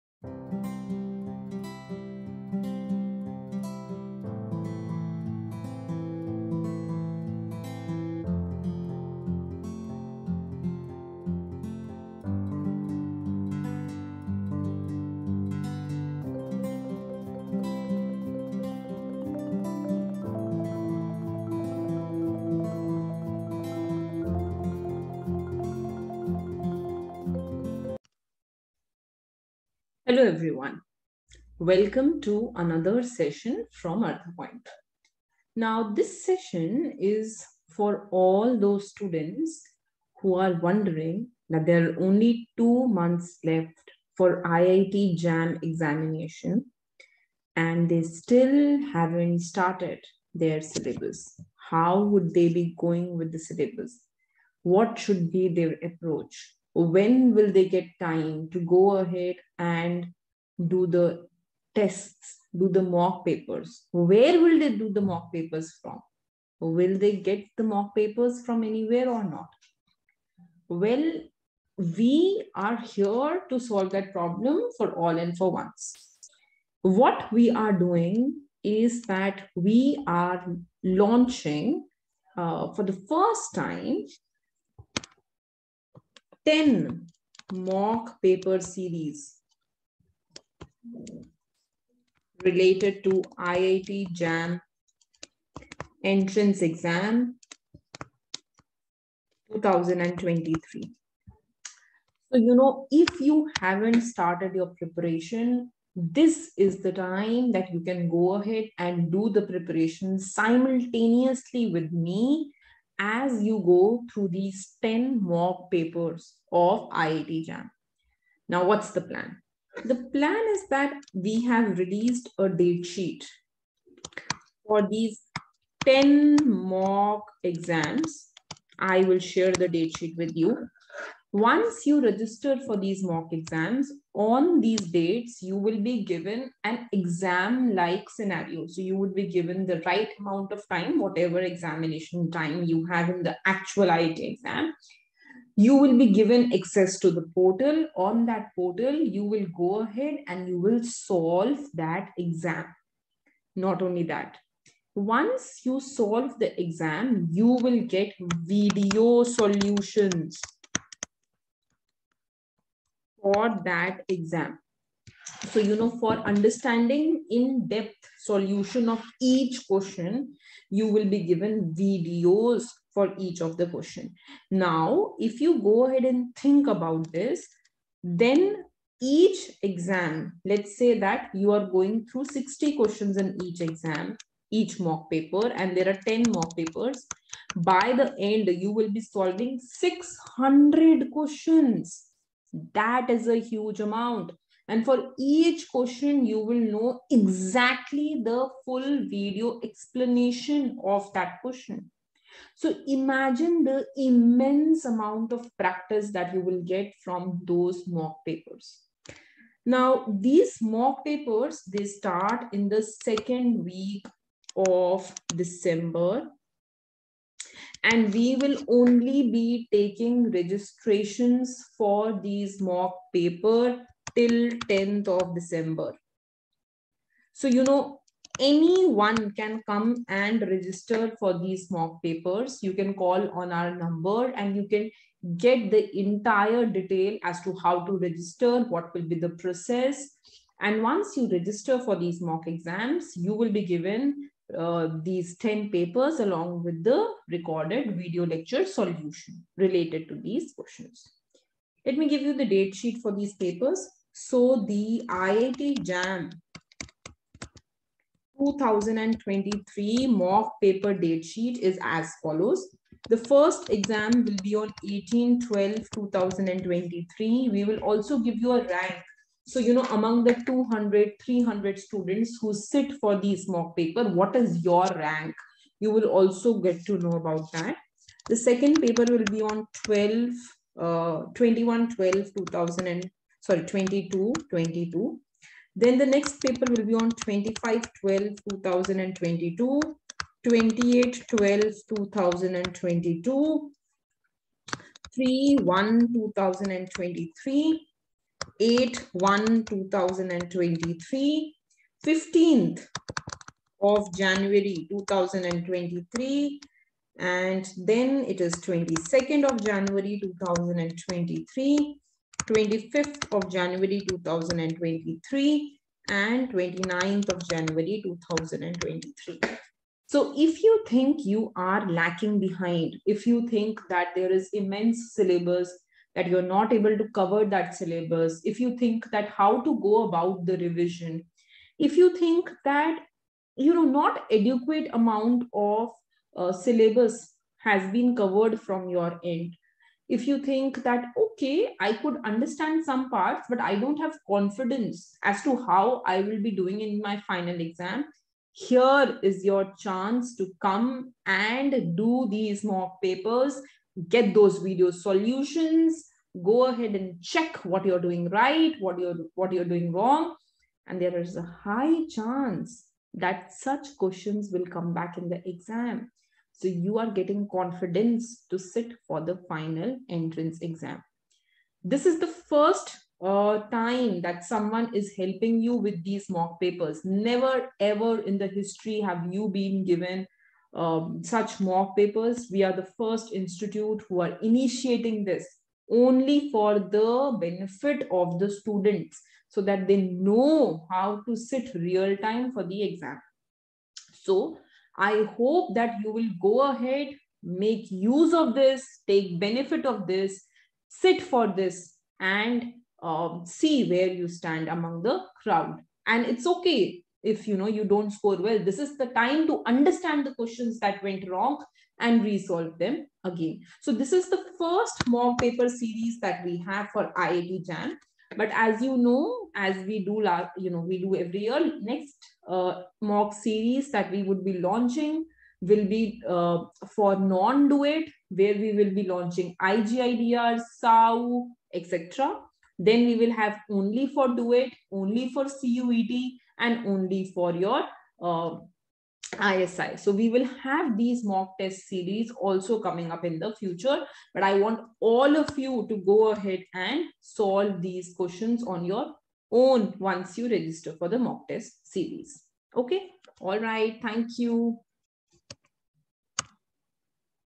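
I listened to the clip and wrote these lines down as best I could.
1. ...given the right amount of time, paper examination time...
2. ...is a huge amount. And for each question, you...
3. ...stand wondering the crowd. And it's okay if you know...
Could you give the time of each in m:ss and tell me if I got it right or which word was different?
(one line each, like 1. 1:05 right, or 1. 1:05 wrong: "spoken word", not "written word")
1. 2:19 wrong: "whatever", not "paper"
2. 3:13 right
3. 6:44 wrong: "among", not "wondering".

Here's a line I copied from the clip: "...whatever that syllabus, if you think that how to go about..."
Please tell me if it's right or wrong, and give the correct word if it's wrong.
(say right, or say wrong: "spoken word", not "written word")
wrong: "cover", not "whatever".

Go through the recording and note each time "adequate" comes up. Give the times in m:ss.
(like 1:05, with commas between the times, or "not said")
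5:34.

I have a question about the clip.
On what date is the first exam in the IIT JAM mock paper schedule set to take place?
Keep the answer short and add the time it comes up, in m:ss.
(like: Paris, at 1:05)
18-12-2023, at 4:24.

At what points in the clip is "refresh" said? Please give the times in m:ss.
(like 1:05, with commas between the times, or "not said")
not said.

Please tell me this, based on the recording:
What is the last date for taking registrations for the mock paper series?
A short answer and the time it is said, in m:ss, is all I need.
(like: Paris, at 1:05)
10th of December, at 3:44.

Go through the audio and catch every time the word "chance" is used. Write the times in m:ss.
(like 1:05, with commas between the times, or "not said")
5:49, 6:02.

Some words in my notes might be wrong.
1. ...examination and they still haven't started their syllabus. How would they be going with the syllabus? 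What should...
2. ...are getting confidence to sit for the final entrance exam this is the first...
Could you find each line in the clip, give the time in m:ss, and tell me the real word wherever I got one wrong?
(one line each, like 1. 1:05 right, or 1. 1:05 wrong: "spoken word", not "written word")
1. 0:45 right
2. 6:06 right.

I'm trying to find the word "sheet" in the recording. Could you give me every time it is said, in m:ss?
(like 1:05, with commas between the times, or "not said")
2:02, 2:09, 4:12, 4:21.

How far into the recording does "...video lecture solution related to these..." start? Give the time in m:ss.
4:07.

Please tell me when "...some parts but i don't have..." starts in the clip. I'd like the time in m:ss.
5:42.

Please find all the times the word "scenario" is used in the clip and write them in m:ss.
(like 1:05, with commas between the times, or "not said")
2:18.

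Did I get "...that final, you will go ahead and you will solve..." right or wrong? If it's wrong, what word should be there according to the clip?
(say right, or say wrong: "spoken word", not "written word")
wrong: "portal", not "final".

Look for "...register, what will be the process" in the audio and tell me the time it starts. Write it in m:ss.
3:57.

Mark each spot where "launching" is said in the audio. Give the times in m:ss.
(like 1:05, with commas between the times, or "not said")
1:20, 7:04, 7:09.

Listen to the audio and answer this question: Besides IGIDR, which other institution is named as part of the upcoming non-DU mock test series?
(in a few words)
SAU.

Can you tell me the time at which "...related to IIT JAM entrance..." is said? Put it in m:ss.
1:32.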